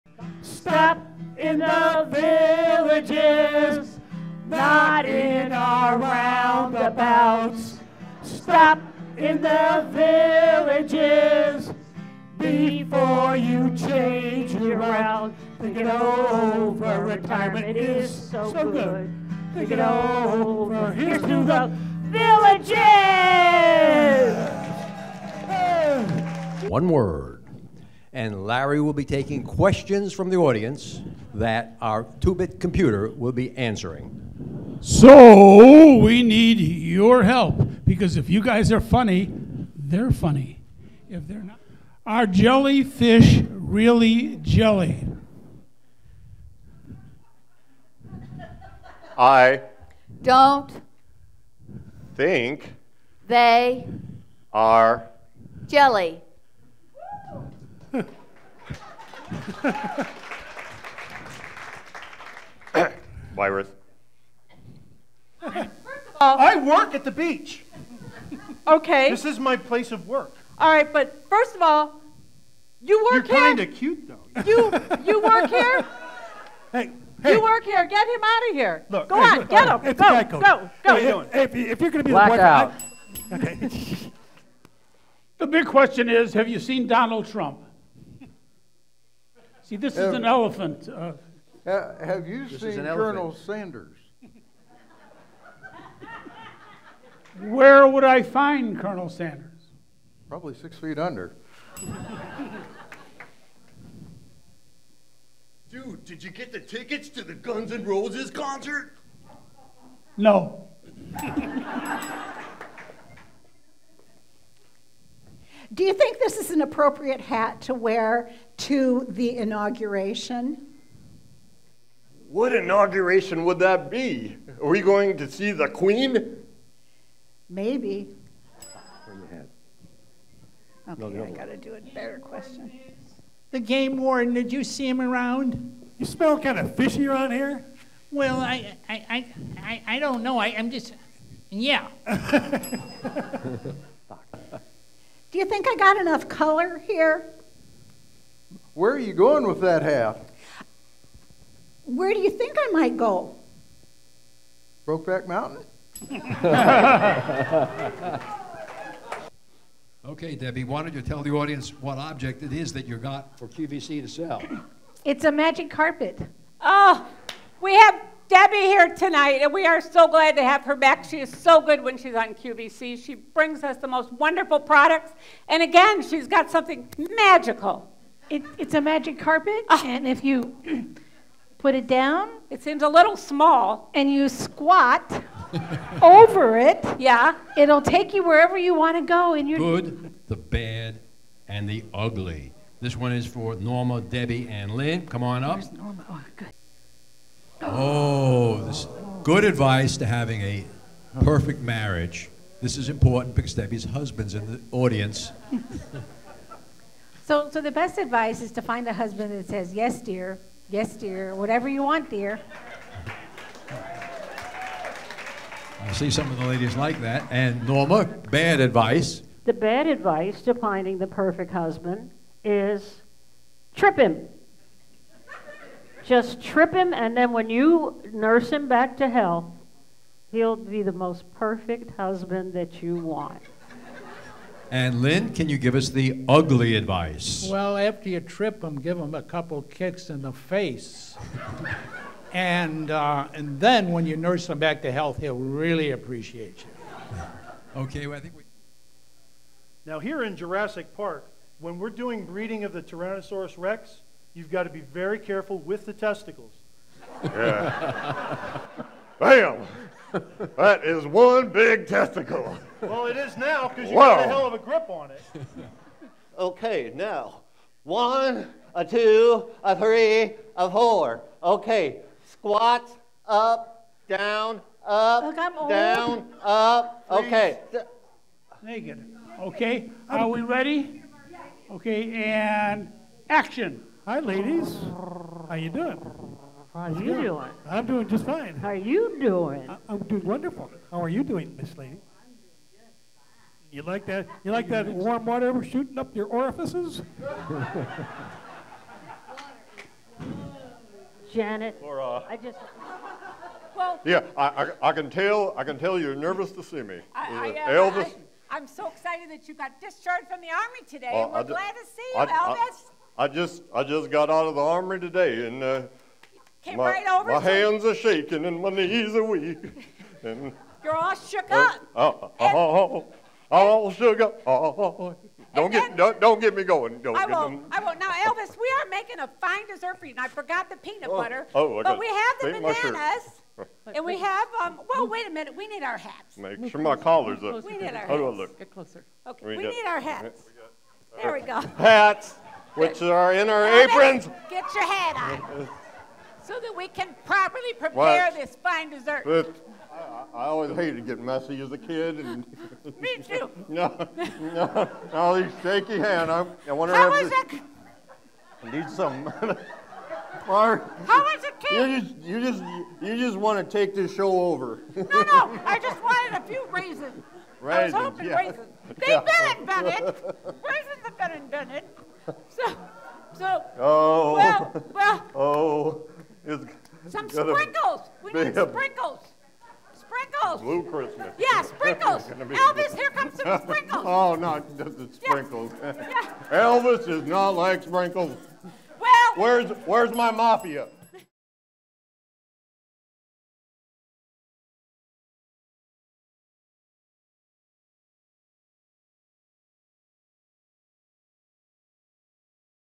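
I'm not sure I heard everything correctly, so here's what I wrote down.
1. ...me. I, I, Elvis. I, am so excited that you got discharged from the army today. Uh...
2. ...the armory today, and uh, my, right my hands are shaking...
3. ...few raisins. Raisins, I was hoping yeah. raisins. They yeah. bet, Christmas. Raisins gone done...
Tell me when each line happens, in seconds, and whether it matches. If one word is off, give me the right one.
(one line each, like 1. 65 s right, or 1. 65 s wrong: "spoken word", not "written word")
1. 306 s right
2. 314 s right
3. 366 s wrong: "Bennett", not "Christmas".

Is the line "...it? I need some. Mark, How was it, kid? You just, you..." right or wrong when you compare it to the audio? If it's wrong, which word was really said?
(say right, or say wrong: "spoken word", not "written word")
right.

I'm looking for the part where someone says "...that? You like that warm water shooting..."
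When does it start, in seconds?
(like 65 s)
294 s.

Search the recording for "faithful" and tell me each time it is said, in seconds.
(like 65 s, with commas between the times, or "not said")
not said.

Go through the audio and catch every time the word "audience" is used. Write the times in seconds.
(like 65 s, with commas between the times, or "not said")
30 s, 161 s, 204 s.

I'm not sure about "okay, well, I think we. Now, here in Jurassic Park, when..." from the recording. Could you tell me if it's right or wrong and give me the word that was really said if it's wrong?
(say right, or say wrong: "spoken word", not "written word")
right.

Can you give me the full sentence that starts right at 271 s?
Okay, squats up, down, up, Look, down, up.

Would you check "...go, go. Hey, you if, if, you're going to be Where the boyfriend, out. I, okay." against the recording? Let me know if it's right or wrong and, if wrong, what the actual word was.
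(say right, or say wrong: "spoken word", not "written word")
wrong: "Black", not "Where".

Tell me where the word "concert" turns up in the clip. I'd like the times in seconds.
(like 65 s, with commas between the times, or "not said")
108 s.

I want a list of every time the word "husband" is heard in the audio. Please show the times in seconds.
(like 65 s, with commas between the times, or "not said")
203 s, 208 s, 221 s, 231 s.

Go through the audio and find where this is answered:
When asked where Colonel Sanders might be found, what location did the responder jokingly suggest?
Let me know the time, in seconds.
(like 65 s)
100 s.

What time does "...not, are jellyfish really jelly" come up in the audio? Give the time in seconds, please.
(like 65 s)
41 s.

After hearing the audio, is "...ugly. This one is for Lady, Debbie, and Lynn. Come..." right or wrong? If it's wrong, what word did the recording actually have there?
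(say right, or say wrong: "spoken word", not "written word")
wrong: "Norma", not "Lady".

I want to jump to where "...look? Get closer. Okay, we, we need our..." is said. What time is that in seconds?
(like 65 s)
338 s.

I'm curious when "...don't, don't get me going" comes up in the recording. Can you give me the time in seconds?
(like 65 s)
325 s.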